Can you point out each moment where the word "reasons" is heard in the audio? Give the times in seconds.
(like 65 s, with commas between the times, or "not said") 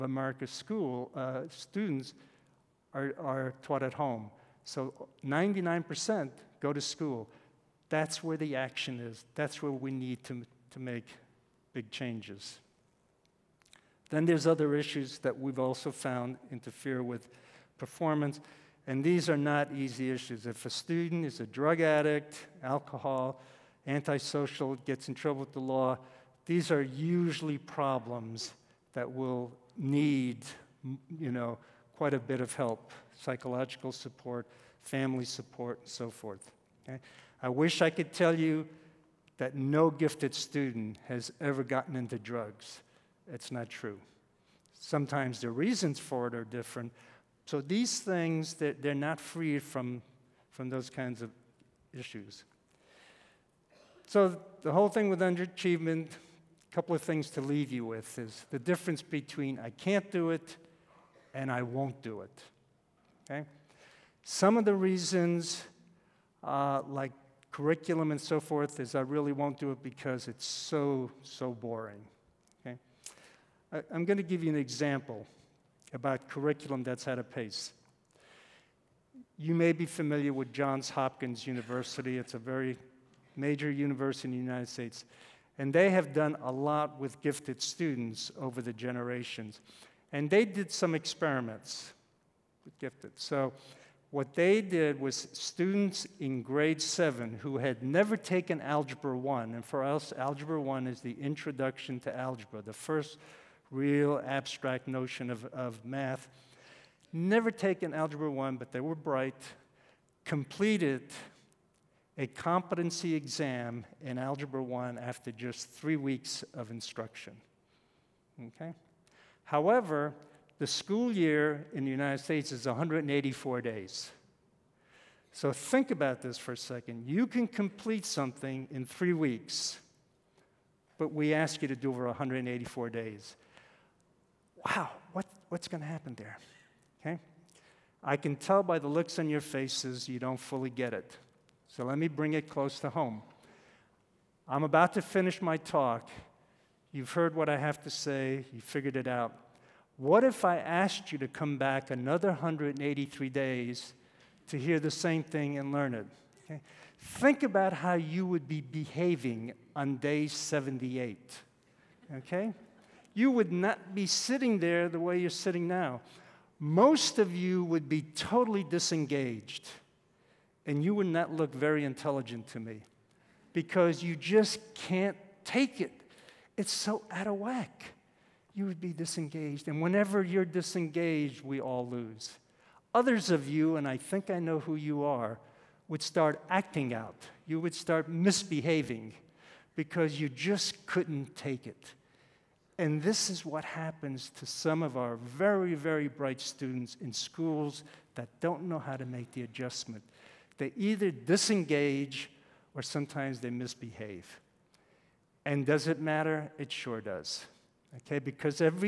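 45 s, 64 s.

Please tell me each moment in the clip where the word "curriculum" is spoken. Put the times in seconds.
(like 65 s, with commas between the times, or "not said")
67 s, 76 s.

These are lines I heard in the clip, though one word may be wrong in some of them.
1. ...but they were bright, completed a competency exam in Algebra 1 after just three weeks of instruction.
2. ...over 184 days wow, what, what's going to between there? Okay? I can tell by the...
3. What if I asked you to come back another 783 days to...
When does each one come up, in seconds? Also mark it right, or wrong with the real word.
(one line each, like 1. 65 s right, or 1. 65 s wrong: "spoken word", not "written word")
1. 108 s right
2. 131 s wrong: "happen", not "between"
3. 149 s wrong: "183", not "783".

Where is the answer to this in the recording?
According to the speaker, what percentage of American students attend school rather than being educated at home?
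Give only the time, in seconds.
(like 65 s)
5 s.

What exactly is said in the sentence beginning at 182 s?
Others of you, and I think I know who you are, would start acting out.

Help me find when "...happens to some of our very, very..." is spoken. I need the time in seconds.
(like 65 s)
193 s.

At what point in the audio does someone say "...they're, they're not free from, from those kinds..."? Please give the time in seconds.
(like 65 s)
48 s.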